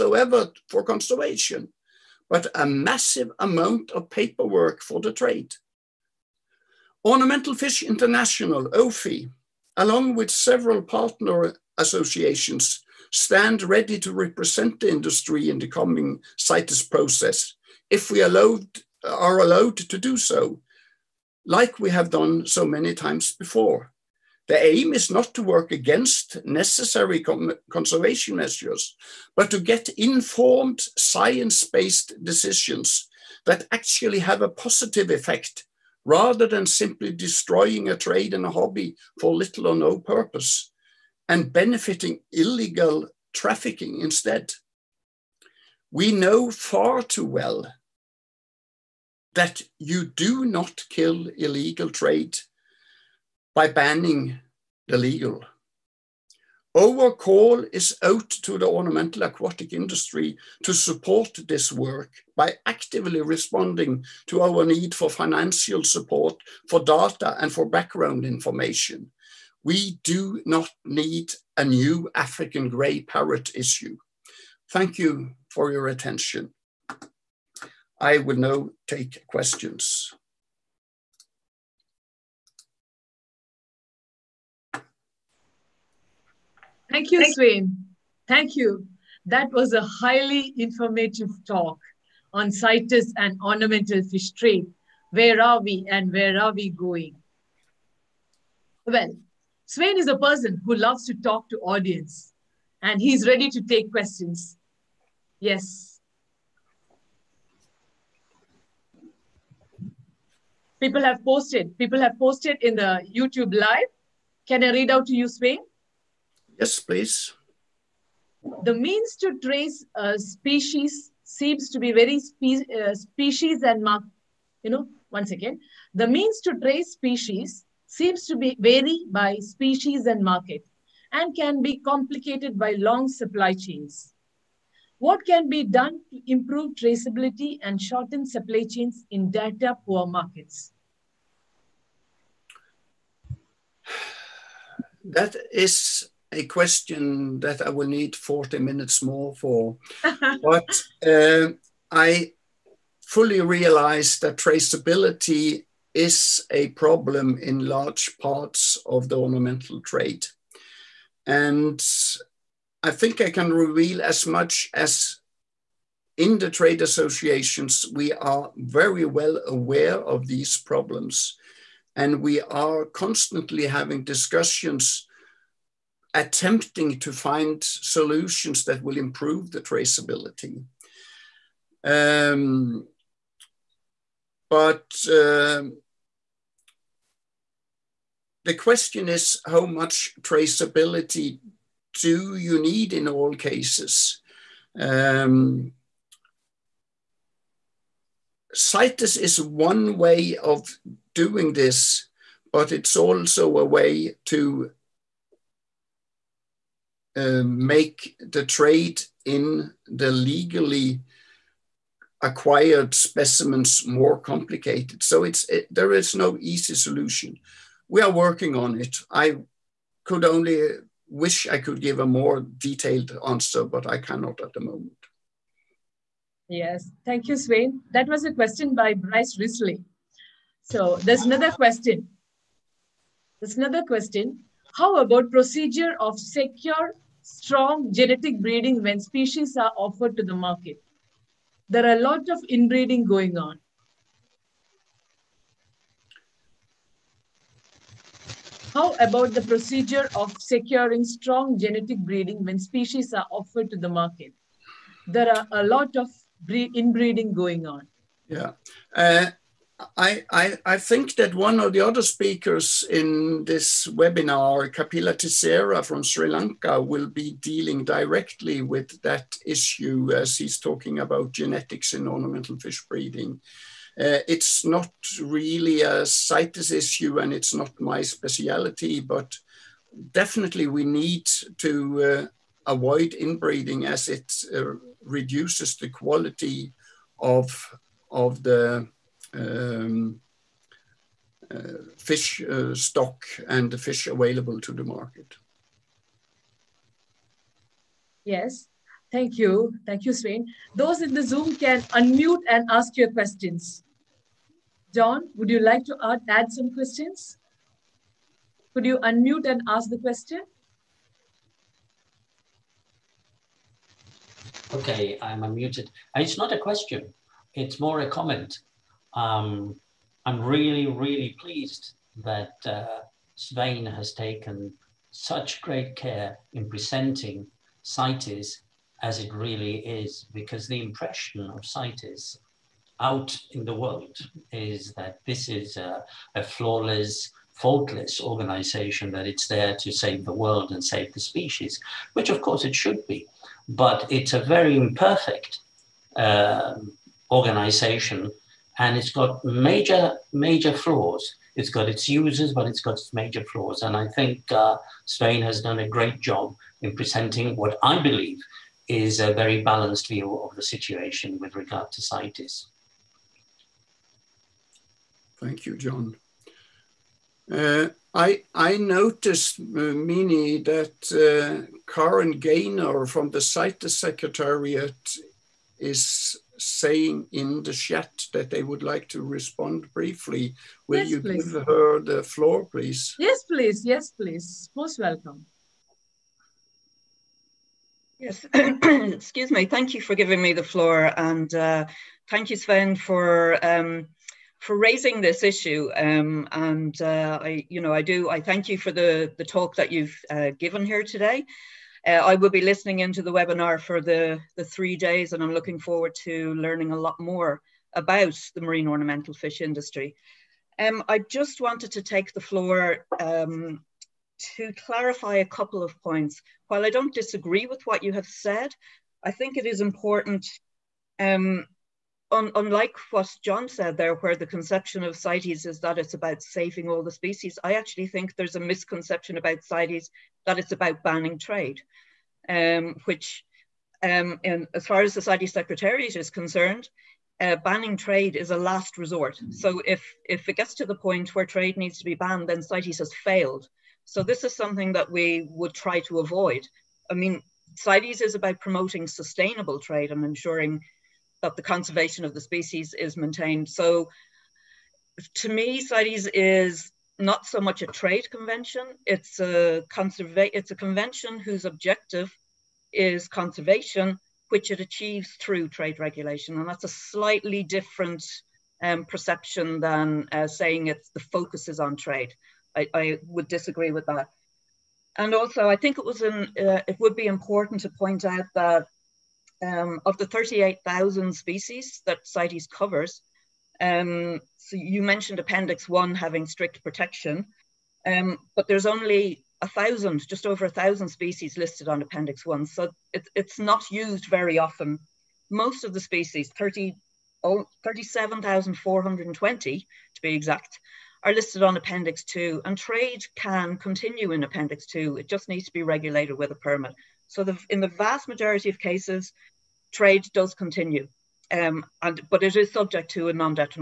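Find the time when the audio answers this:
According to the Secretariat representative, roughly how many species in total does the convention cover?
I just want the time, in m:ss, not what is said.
8:00.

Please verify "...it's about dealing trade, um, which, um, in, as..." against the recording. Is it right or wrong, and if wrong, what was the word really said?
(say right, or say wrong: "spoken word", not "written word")
wrong: "banning", not "dealing".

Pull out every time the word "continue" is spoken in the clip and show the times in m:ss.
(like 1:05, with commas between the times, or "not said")
8:23, 8:30.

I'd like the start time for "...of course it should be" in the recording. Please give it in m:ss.
5:42.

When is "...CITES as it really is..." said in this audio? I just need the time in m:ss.
5:27.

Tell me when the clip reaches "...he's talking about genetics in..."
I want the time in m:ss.
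4:30.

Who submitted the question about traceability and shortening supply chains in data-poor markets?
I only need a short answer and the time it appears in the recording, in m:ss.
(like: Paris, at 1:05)
Bryce Risley, at 3:48.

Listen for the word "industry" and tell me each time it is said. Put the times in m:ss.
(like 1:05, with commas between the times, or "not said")
0:14, 0:59, 6:49.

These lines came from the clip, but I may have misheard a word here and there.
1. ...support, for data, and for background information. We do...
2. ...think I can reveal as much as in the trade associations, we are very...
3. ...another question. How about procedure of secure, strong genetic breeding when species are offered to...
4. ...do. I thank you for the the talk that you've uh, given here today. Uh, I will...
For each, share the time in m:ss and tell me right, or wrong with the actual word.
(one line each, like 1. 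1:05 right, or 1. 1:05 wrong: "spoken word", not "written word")
1. 1:05 right
2. 2:42 right
3. 3:53 right
4. 6:38 right.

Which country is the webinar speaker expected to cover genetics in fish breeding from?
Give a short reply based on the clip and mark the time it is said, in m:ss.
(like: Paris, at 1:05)
Sri Lanka, at 4:26.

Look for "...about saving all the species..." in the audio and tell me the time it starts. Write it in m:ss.
7:06.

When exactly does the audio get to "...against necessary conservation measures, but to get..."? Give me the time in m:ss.
0:25.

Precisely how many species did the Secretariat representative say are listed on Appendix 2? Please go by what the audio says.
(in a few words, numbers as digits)
37,420.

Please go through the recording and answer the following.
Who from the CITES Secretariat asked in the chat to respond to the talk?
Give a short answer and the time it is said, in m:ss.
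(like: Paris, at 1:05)
Karen Gaynor, at 6:11.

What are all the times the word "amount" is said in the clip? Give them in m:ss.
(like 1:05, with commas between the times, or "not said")
0:03.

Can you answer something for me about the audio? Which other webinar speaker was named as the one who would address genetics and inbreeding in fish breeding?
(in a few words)
Kapila Tissera.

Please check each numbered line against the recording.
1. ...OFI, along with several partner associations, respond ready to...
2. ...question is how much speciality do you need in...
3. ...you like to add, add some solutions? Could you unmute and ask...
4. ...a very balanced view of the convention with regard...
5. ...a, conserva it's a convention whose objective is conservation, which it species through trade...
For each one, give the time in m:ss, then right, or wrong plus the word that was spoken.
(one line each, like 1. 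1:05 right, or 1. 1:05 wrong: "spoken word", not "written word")
1. 0:08 wrong: "stand", not "respond"
2. 3:08 wrong: "traceability", not "speciality"
3. 5:05 wrong: "questions", not "solutions"
4. 5:59 wrong: "situation", not "convention"
5. 7:39 wrong: "achieves", not "species".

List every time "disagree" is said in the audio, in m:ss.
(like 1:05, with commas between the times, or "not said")
6:57, 7:53.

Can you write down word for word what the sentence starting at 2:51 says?
And we are constantly having discussions attempting to find solutions that will improve the traceability.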